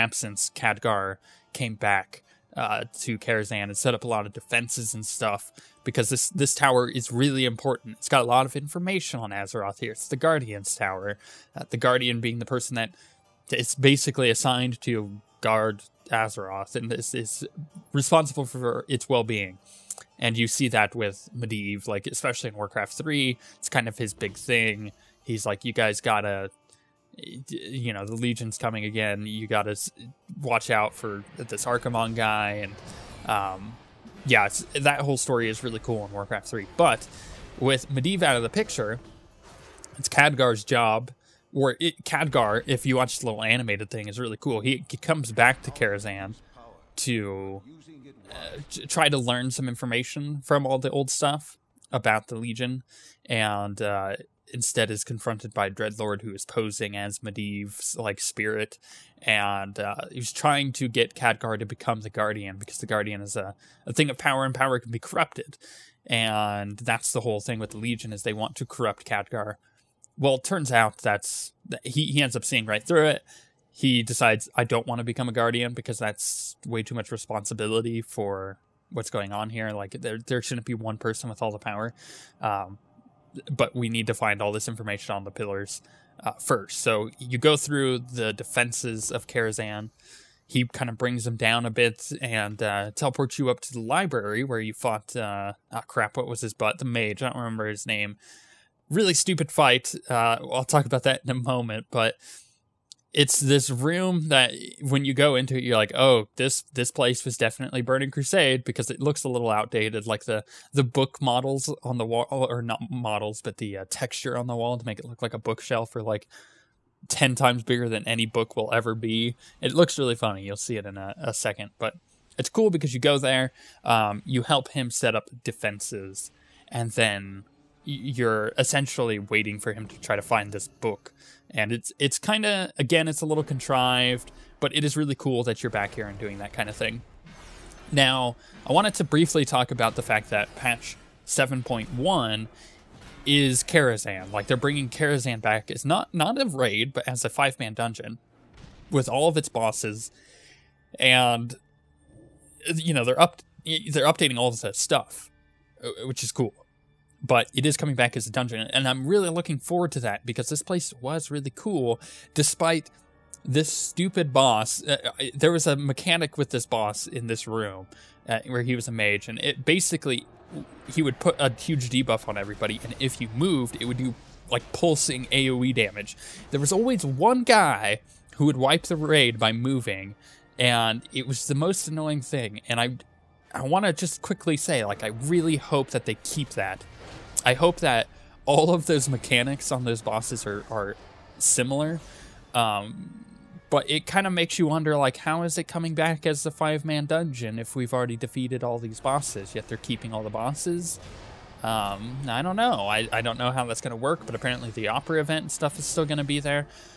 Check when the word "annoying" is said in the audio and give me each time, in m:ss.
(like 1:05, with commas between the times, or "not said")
3:01.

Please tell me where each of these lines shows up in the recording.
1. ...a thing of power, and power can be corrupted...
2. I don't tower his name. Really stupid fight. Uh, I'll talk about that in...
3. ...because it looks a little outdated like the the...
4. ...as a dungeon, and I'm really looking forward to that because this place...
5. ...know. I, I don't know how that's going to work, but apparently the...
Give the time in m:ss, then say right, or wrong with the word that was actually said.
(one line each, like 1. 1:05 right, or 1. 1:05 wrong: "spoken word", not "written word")
1. 1:03 right
2. 1:37 wrong: "remember", not "tower"
3. 1:48 right
4. 2:38 right
5. 3:22 right.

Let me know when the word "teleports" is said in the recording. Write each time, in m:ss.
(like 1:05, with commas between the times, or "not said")
1:32.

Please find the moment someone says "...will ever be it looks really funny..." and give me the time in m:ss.
1:58.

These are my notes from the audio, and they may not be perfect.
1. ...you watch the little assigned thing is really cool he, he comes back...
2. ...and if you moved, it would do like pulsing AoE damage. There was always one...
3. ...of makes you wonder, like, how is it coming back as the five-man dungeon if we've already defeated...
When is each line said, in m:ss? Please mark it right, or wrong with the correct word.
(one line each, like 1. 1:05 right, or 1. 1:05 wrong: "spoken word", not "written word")
1. 0:42 wrong: "animated", not "assigned"
2. 2:52 right
3. 3:14 right.